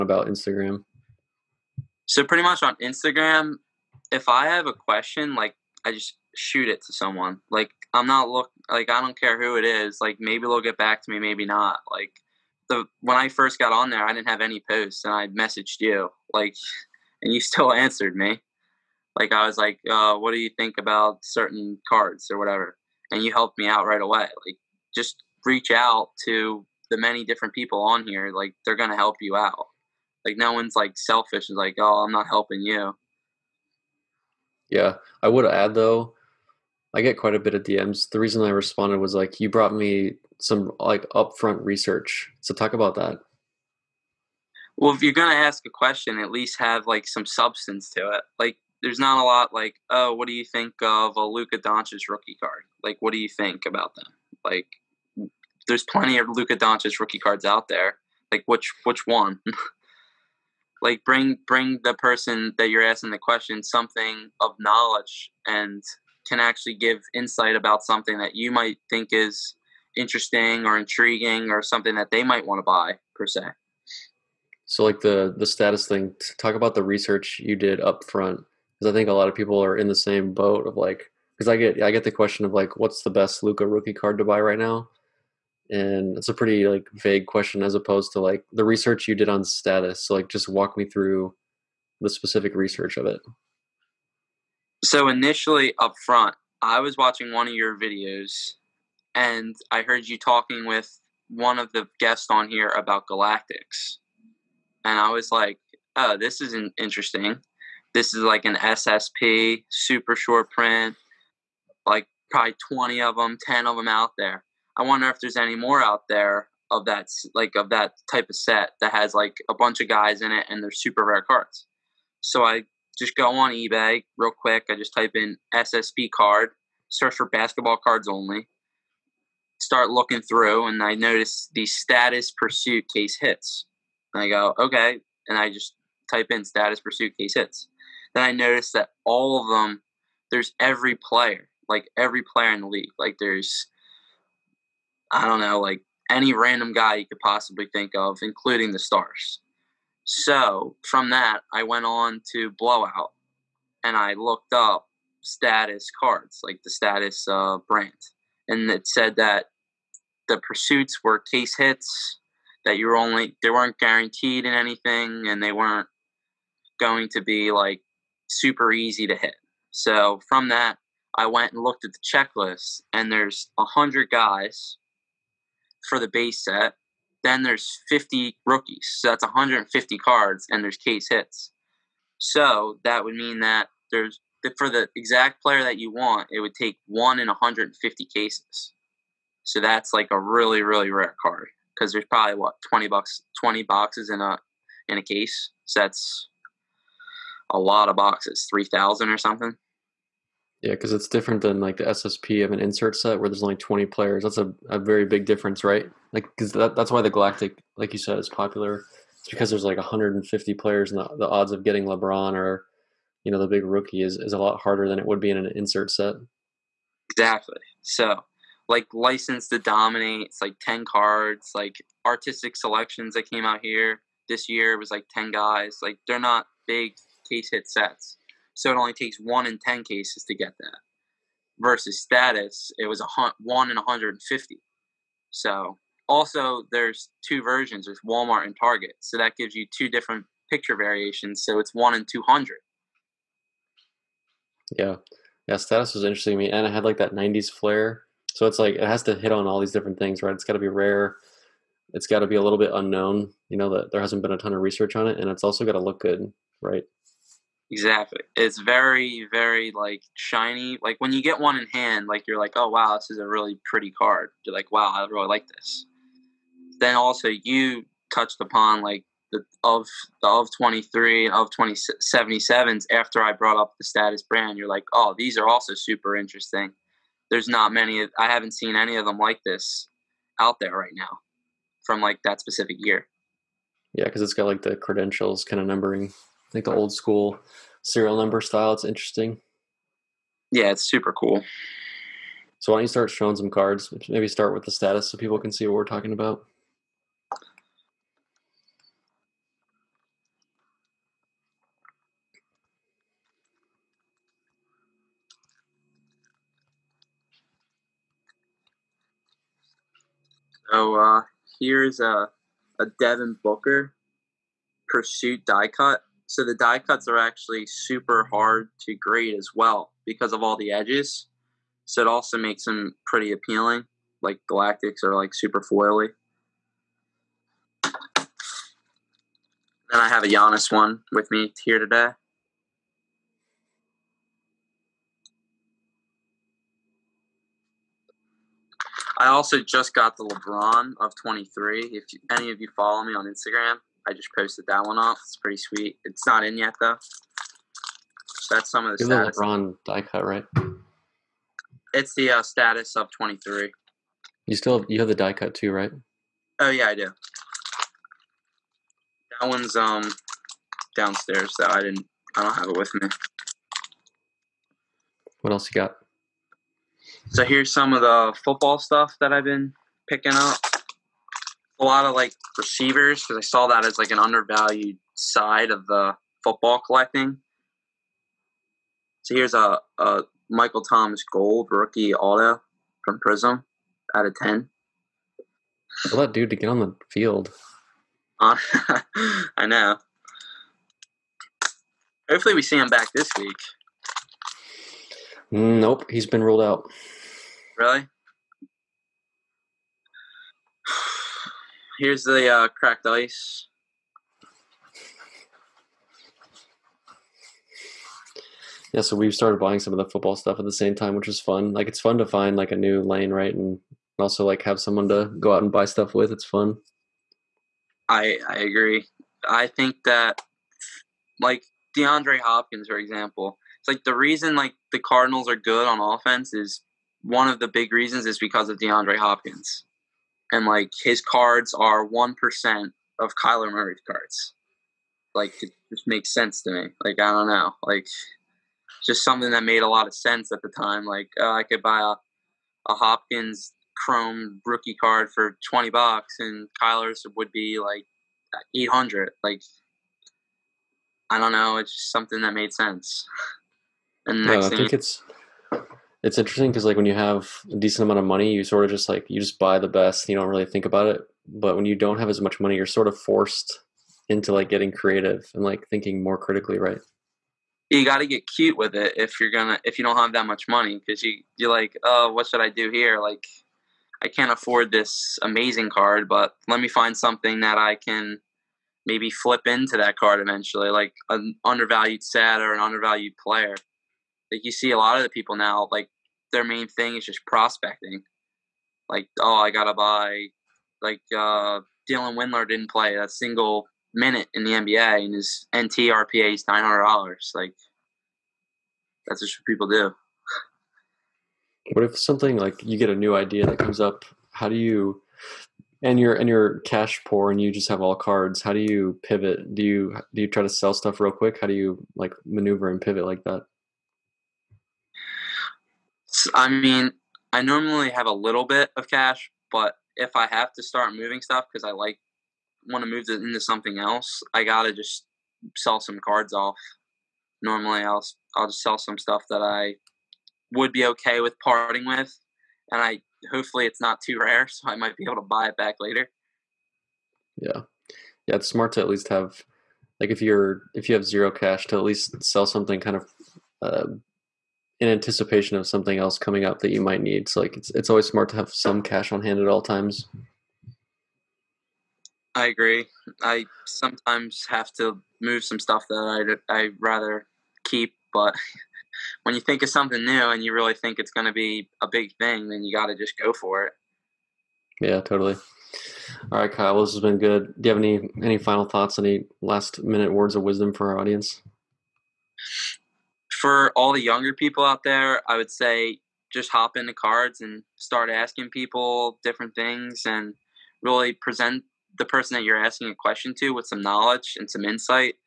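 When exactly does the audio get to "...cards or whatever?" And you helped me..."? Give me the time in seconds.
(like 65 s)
21 s.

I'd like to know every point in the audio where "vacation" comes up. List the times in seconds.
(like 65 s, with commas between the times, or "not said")
not said.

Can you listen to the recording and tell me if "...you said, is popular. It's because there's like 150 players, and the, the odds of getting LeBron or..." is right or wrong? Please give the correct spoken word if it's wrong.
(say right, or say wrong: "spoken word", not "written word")
right.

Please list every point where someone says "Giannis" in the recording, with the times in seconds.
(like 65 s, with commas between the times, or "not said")
330 s.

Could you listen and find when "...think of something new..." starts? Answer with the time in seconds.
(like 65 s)
559 s.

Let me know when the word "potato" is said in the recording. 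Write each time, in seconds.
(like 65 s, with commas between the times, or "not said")
not said.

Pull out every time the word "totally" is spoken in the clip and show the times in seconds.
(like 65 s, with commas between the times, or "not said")
565 s.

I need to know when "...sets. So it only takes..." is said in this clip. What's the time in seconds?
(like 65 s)
227 s.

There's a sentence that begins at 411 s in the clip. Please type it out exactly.
Like it's fun to find like a new lane, right, and also like have someone to go out and buy stuff with.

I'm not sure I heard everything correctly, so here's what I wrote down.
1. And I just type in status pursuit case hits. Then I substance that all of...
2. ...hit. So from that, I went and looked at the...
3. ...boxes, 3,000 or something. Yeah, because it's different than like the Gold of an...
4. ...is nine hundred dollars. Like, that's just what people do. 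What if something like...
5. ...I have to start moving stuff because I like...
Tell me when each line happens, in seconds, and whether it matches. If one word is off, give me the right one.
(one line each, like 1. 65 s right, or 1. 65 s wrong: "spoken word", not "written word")
1. 135 s wrong: "notice", not "substance"
2. 169 s right
3. 197 s wrong: "SSP", not "Gold"
4. 496 s right
5. 520 s right.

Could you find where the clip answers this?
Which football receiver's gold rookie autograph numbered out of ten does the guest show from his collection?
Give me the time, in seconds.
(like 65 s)
380 s.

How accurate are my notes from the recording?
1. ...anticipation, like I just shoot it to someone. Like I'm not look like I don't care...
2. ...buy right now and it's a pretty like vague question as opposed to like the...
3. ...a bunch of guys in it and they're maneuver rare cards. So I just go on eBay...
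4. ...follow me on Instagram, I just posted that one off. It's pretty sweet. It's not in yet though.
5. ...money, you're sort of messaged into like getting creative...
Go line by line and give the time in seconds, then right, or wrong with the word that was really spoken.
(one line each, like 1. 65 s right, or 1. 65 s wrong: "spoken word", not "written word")
1. 4 s wrong: "question", not "anticipation"
2. 84 s right
3. 119 s wrong: "super", not "maneuver"
4. 342 s right
5. 462 s wrong: "forced", not "messaged".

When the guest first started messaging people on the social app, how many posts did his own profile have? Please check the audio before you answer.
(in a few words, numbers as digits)
0.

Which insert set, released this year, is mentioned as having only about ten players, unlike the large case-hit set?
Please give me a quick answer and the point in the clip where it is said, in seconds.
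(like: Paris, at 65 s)
Artistic Selections, at 222 s.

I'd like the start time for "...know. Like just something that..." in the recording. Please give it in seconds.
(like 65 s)
437 s.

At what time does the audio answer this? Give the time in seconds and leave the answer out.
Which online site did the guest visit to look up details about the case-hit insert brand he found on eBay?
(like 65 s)
152 s.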